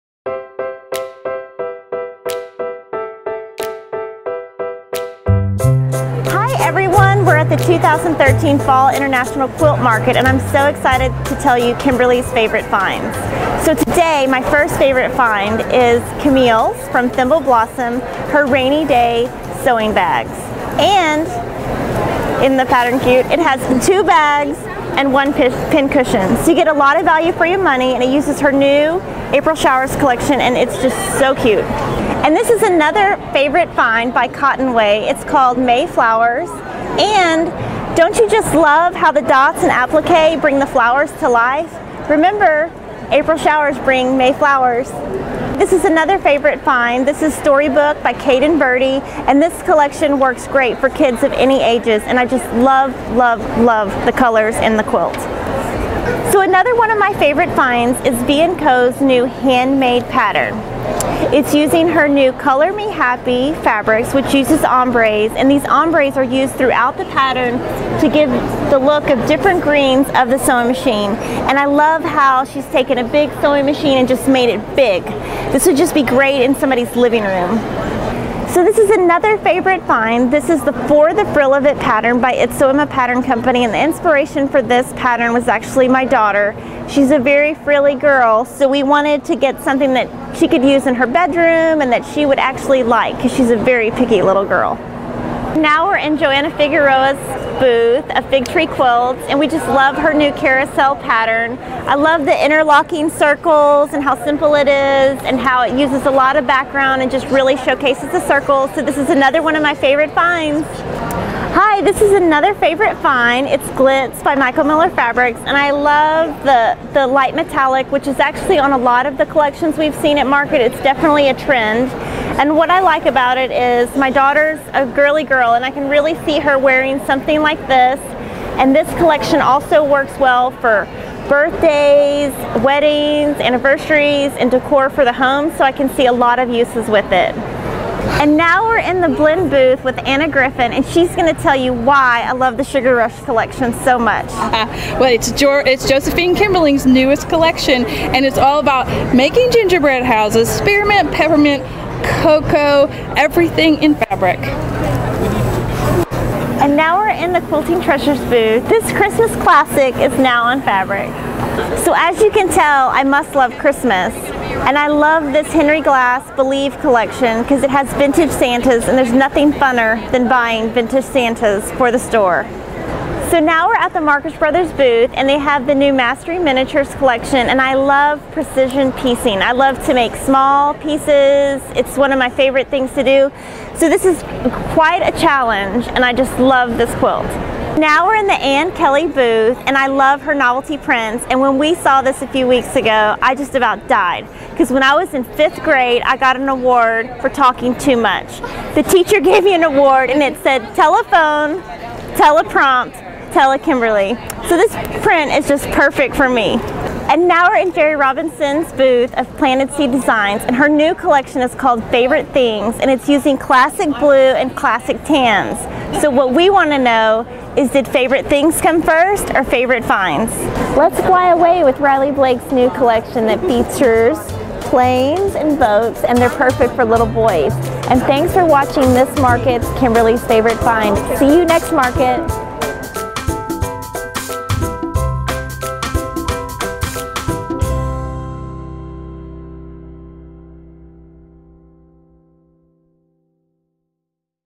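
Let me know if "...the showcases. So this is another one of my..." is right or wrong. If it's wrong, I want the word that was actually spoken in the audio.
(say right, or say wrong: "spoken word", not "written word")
wrong: "circles", not "showcases".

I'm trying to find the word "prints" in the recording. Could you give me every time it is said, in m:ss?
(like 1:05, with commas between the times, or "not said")
3:10, 3:25.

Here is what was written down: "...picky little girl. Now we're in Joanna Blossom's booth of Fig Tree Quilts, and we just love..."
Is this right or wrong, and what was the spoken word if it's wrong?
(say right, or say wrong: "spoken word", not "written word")
wrong: "Figueroa", not "Blossom".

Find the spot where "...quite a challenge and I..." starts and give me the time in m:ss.
3:04.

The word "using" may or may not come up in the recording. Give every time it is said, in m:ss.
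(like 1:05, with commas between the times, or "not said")
1:01, 3:33.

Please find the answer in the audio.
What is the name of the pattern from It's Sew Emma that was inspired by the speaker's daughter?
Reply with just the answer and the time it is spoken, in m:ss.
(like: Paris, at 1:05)
For the Frill of It, at 1:20.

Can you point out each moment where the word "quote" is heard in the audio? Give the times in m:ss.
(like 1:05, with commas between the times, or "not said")
not said.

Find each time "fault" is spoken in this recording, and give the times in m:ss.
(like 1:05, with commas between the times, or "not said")
not said.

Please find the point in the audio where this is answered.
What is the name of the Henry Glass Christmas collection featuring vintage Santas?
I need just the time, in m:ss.
2:46.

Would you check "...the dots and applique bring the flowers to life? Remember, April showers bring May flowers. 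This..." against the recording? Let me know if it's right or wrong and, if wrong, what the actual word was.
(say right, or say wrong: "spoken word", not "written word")
right.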